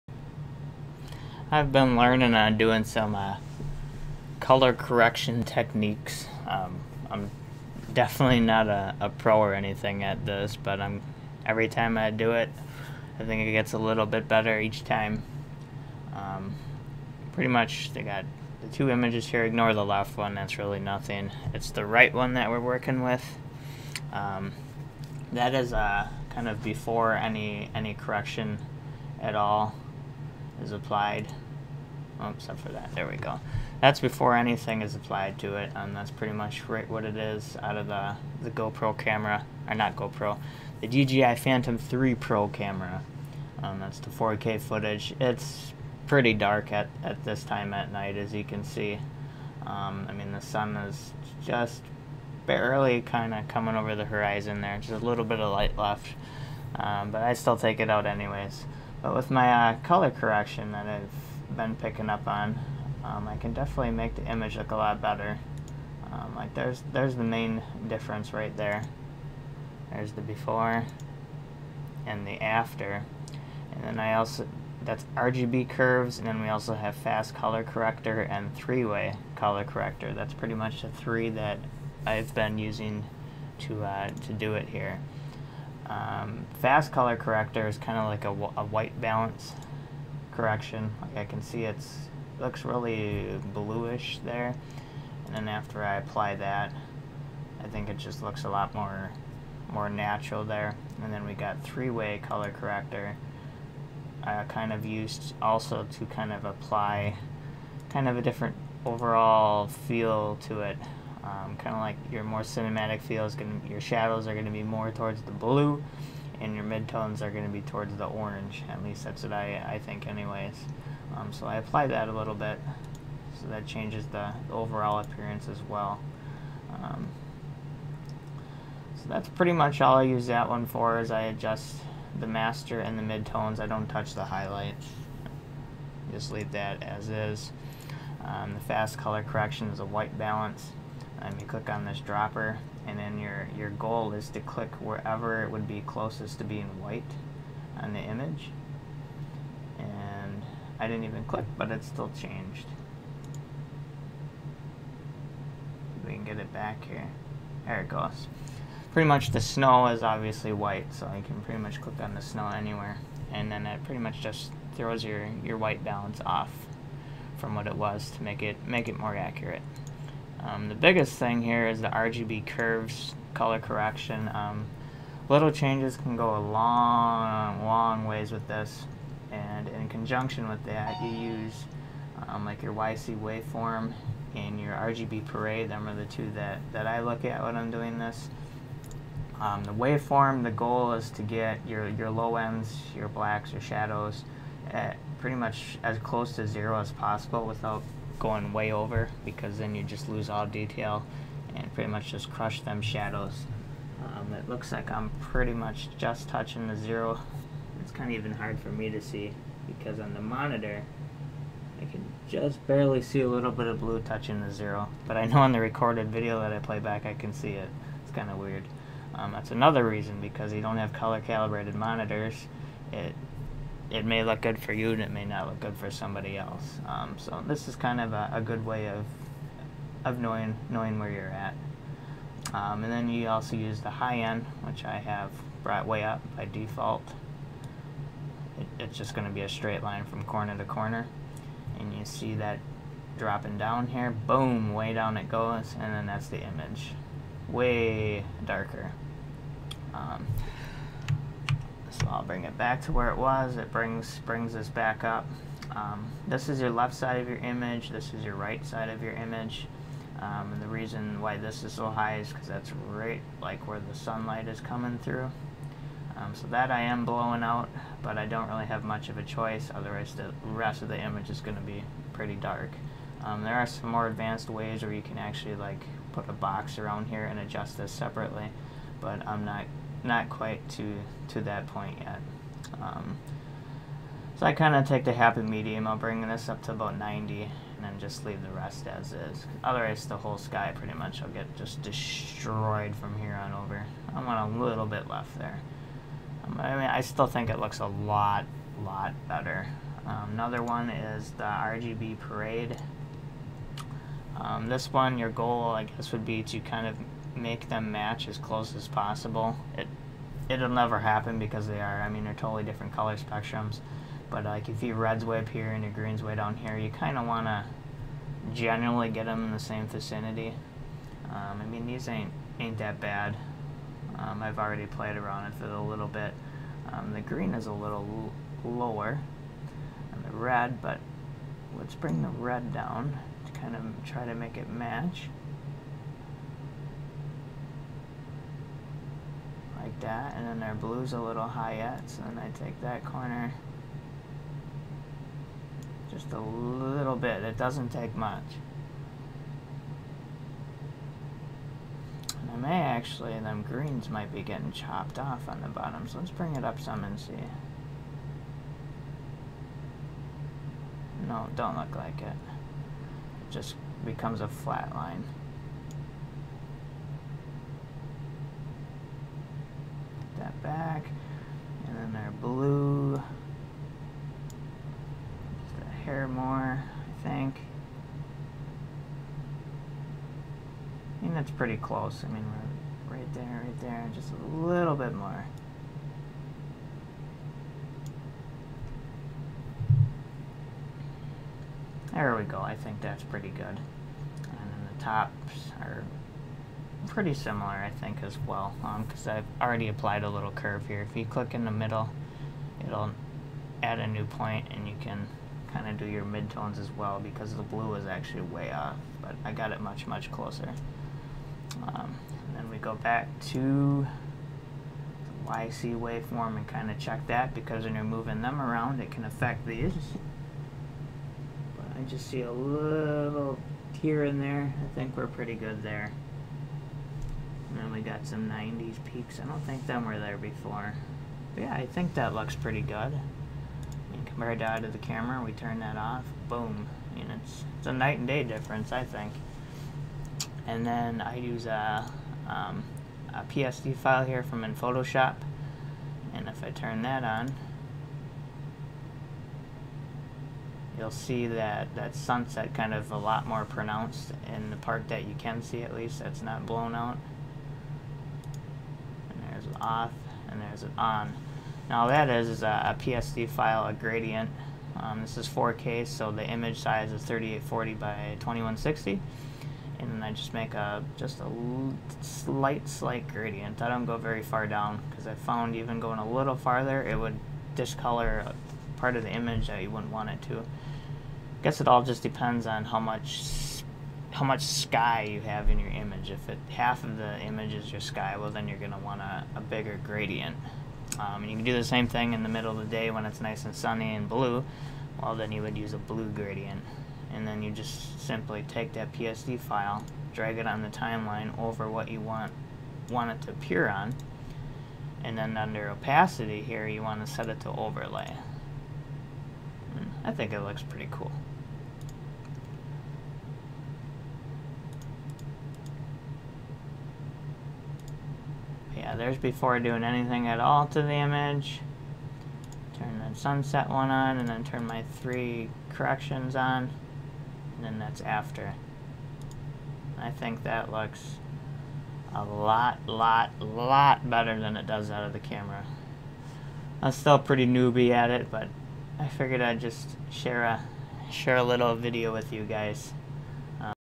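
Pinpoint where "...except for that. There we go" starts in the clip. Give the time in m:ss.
0:32.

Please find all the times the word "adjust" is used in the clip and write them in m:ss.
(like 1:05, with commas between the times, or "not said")
2:11, 4:37.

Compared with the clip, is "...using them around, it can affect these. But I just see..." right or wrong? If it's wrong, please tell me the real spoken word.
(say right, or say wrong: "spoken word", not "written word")
wrong: "moving", not "using".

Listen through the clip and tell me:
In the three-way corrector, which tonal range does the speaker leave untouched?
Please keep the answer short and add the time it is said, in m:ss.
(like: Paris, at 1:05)
highlight, at 2:13.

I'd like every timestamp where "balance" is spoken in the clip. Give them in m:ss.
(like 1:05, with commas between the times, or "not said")
1:29, 2:20, 2:45.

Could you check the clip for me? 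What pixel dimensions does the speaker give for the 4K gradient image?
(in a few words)
3840 by 2160.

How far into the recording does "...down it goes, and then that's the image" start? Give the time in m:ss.
4:04.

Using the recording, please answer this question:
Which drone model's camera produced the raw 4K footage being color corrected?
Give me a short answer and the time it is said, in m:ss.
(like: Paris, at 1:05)
DJI Phantom 3 Pro, at 0:40.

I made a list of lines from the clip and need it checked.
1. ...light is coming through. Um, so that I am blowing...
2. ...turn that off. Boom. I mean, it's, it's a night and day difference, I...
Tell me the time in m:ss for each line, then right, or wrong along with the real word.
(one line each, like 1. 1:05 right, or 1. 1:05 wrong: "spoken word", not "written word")
1. 4:23 wrong: "sunlight", not "light"
2. 7:15 right.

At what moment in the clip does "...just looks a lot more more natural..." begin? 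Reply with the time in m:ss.
1:37.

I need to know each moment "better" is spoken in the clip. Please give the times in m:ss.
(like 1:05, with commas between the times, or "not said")
0:14, 1:05, 4:59, 8:54.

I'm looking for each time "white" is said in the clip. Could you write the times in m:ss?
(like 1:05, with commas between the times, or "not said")
1:28, 2:19, 2:26, 2:40, 2:45.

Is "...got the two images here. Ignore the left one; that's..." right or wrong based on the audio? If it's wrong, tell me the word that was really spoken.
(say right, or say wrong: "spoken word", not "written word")
right.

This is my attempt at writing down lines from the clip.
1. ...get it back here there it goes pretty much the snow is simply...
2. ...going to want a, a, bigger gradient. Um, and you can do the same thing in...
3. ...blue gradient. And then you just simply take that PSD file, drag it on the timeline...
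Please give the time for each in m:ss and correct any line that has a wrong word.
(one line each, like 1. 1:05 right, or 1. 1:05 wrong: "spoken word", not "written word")
1. 2:36 wrong: "obviously", not "simply"
2. 8:08 right
3. 8:15 right.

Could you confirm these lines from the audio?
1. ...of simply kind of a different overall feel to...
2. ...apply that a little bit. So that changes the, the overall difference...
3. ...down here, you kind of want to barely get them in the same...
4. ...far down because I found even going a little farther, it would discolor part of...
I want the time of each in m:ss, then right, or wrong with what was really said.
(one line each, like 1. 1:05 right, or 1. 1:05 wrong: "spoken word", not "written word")
1. 1:46 wrong: "apply", not "simply"
2. 2:01 wrong: "appearance", not "difference"
3. 5:16 wrong: "generally", not "barely"
4. 7:54 right.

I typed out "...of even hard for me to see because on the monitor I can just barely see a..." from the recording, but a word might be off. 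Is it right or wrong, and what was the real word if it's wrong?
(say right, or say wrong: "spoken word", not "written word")
right.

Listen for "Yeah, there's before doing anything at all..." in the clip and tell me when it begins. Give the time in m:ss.
8:39.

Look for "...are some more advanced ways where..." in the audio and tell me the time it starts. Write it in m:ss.
4:33.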